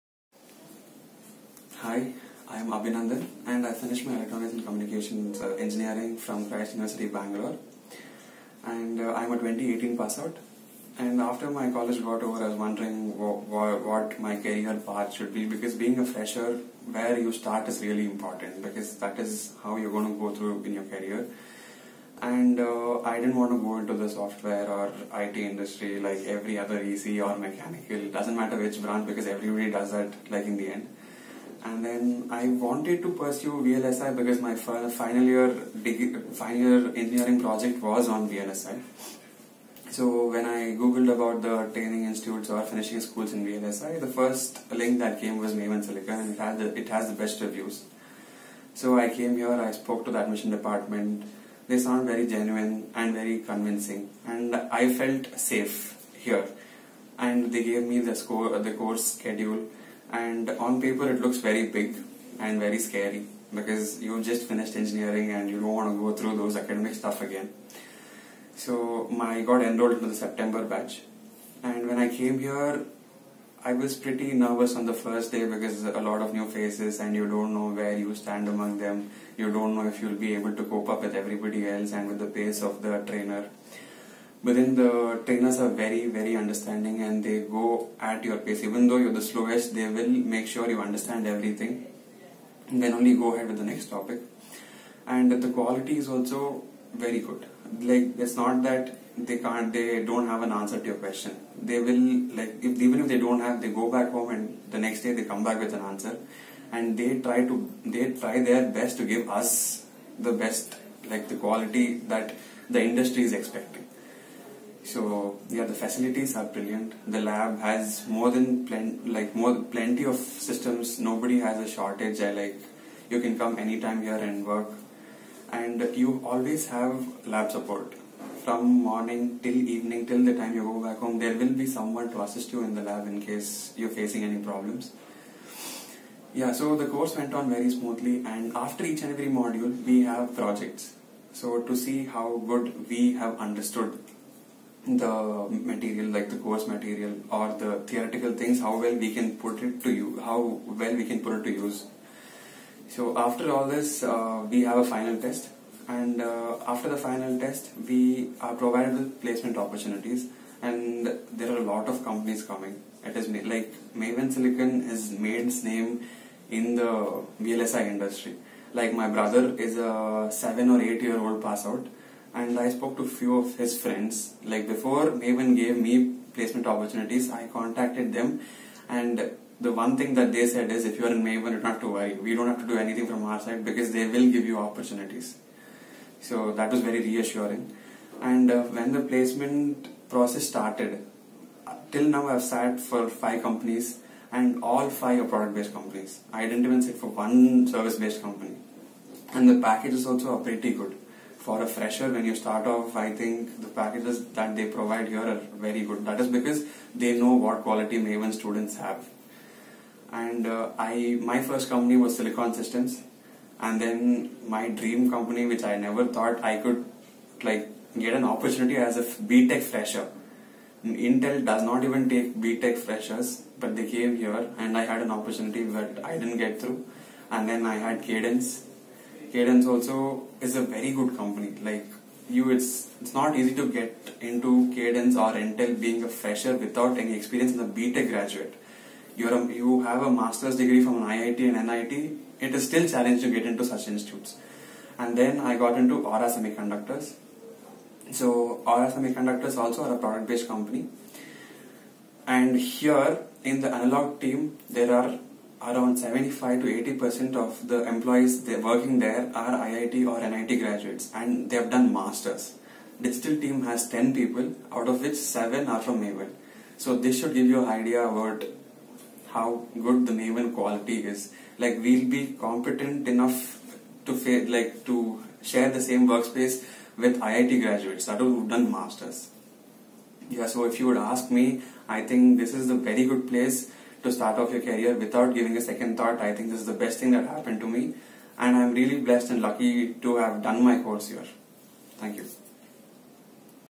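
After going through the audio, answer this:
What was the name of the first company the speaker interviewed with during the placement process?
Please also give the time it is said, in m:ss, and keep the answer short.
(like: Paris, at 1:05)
Silicon Systems, at 3:32.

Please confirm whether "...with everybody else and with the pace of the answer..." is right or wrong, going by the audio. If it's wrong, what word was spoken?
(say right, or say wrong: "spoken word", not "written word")
wrong: "trainer", not "answer".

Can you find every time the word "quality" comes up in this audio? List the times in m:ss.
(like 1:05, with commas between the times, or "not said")
1:35, 1:51, 3:27, 4:30.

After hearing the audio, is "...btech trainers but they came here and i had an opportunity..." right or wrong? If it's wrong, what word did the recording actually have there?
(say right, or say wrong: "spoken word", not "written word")
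wrong: "freshers", not "trainers".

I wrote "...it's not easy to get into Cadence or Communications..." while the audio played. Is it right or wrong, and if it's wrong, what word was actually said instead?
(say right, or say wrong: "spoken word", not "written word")
wrong: "Intel", not "Communications".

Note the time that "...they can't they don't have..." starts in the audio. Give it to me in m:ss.
1:39.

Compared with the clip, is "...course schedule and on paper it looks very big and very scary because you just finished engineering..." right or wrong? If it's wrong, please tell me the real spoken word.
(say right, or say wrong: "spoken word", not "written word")
right.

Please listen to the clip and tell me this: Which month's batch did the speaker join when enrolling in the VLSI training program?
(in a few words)
September.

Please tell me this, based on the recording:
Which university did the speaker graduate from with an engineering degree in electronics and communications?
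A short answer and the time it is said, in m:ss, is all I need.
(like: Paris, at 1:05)
Christ University, at 0:06.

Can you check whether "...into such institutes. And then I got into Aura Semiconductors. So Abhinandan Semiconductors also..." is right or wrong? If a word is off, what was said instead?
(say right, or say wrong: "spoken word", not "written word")
wrong: "Aura", not "Abhinandan".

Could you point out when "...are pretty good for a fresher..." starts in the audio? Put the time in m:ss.
3:20.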